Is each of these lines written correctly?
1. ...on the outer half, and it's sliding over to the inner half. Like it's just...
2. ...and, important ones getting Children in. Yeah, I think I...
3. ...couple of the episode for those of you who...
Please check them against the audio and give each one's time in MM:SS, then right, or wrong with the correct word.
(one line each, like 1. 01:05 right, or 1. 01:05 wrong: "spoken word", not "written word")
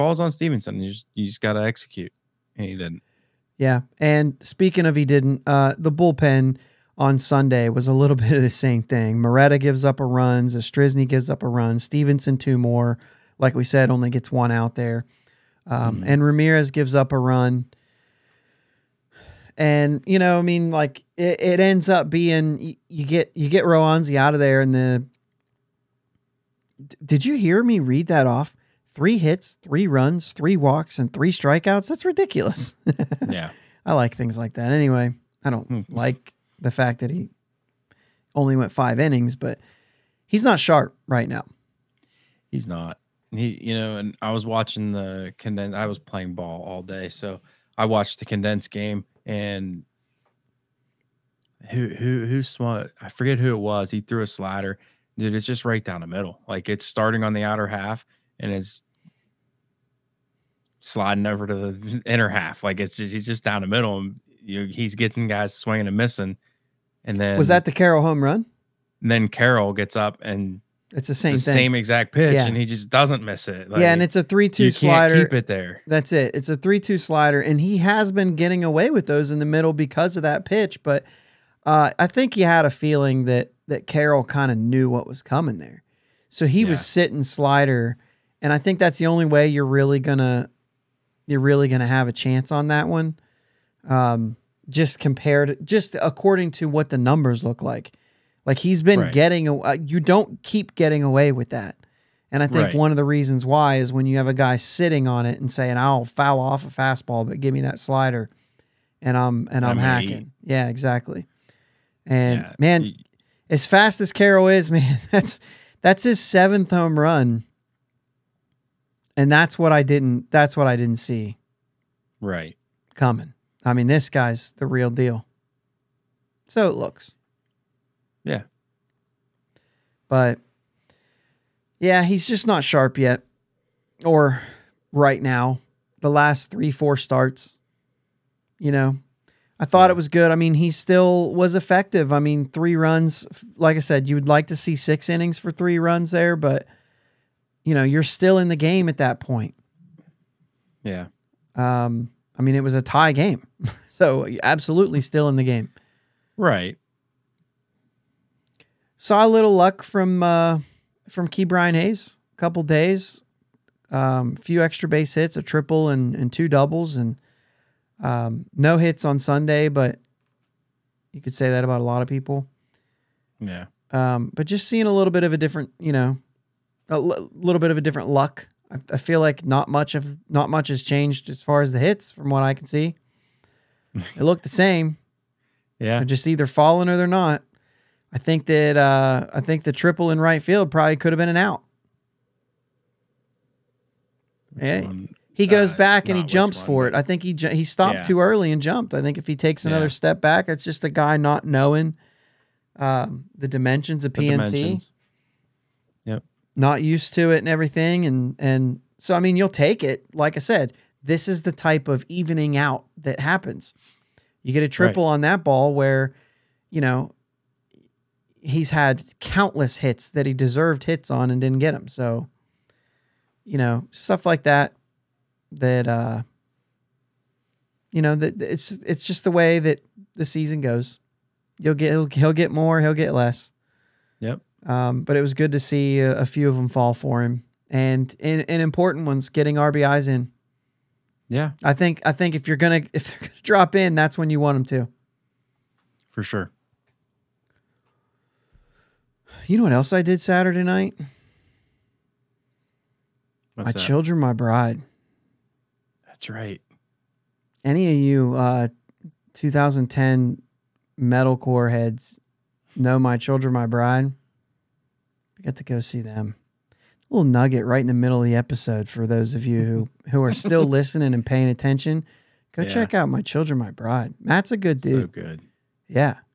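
1. 00:57 right
2. 03:58 wrong: "RBIs", not "Children"
3. 04:27 wrong: "middle", not "couple".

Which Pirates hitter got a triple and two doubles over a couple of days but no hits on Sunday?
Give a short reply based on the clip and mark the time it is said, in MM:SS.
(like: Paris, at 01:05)
Ke'Bryan Hayes, at 02:41.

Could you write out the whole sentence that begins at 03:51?
You'll get he'll, he'll get more, he'll get less.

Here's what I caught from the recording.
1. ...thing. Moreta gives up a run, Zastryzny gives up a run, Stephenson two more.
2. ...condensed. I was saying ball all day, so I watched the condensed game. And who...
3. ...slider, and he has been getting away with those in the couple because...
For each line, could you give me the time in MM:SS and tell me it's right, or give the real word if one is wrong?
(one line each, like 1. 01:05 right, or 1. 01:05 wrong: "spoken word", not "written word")
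1. 00:08 right
2. 00:45 wrong: "playing", not "saying"
3. 01:16 wrong: "middle", not "couple".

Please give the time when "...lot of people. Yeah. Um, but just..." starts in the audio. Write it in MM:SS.
02:51.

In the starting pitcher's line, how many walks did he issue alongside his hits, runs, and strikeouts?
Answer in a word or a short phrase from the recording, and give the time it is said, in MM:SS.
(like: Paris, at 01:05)
3, at 00:30.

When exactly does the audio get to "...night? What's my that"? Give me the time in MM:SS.
04:10.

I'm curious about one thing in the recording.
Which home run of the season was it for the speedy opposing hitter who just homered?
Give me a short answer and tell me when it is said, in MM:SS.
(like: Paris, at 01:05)
7th, at 01:56.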